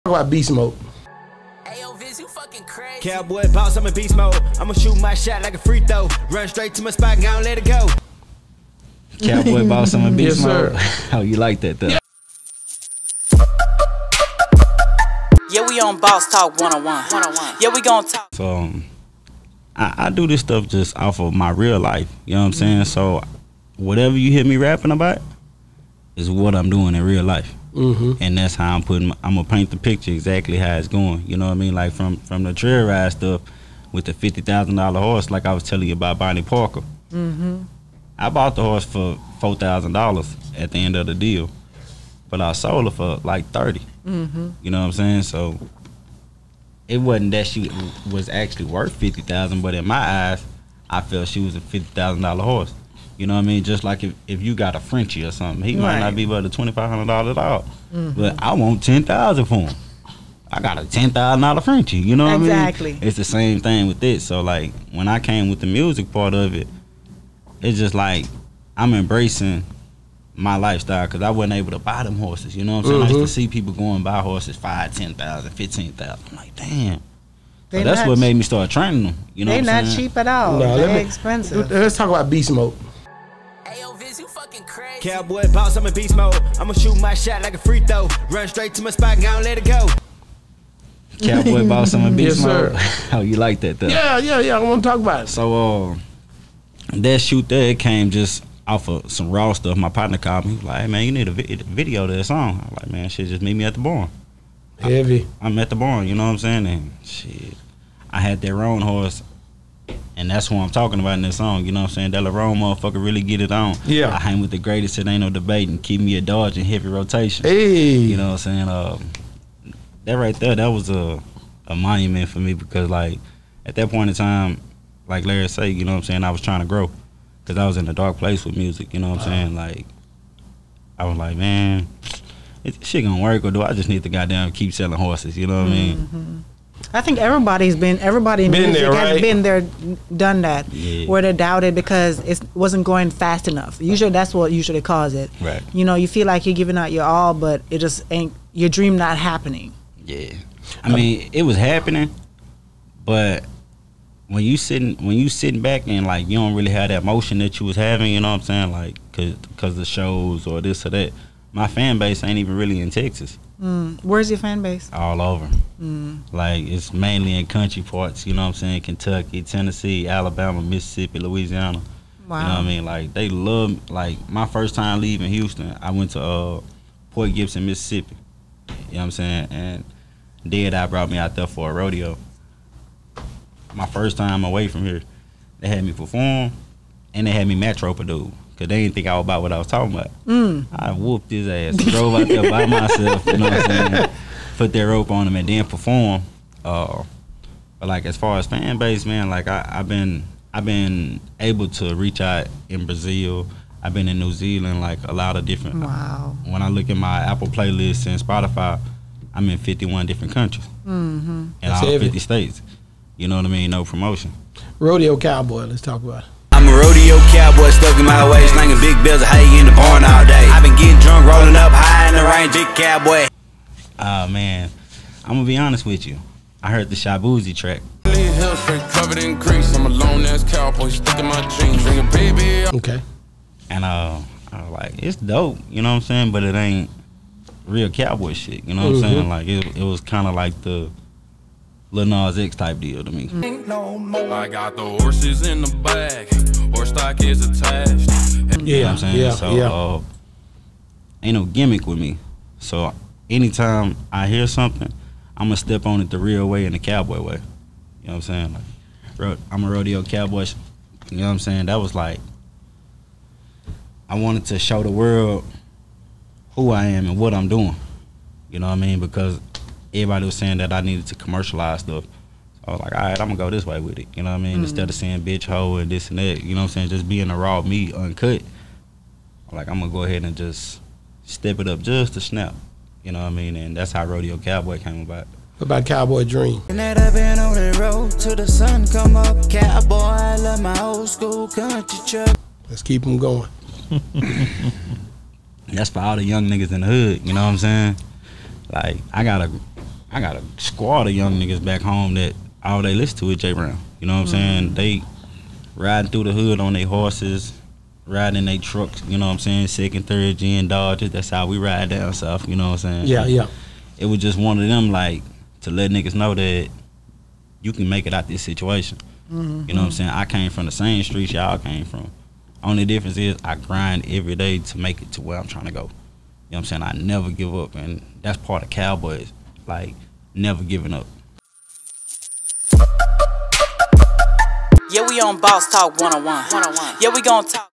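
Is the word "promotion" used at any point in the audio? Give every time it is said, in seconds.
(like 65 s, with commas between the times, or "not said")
213 s.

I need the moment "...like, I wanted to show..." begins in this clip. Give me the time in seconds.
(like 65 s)
261 s.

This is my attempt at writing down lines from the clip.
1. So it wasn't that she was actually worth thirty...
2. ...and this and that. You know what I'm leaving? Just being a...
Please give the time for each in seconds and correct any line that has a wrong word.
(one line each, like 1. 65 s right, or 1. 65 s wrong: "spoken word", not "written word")
1. 45 s wrong: "fifty", not "thirty"
2. 275 s wrong: "saying", not "leaving".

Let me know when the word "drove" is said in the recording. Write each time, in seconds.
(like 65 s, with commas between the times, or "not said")
191 s.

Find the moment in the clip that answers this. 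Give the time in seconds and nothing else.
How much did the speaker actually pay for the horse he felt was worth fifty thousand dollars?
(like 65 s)
39 s.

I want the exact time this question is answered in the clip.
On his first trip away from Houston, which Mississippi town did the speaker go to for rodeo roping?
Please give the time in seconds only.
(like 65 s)
177 s.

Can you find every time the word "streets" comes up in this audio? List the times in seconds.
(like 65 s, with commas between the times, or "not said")
321 s.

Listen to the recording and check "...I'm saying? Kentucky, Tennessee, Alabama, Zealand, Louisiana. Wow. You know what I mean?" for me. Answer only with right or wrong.
wrong.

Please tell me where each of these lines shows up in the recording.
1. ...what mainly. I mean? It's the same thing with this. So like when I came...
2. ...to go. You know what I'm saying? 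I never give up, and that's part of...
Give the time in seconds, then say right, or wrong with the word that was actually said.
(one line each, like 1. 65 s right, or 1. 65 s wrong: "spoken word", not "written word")
1. 62 s wrong: "exactly", not "mainly"
2. 325 s right.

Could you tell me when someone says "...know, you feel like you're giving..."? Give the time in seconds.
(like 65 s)
145 s.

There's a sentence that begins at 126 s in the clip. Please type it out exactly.
I was trying to grow because I was in a dark place with music.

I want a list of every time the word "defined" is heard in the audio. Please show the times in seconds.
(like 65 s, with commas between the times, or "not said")
not said.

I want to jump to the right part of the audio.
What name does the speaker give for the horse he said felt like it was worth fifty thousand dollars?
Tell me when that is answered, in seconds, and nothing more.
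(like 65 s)
36 s.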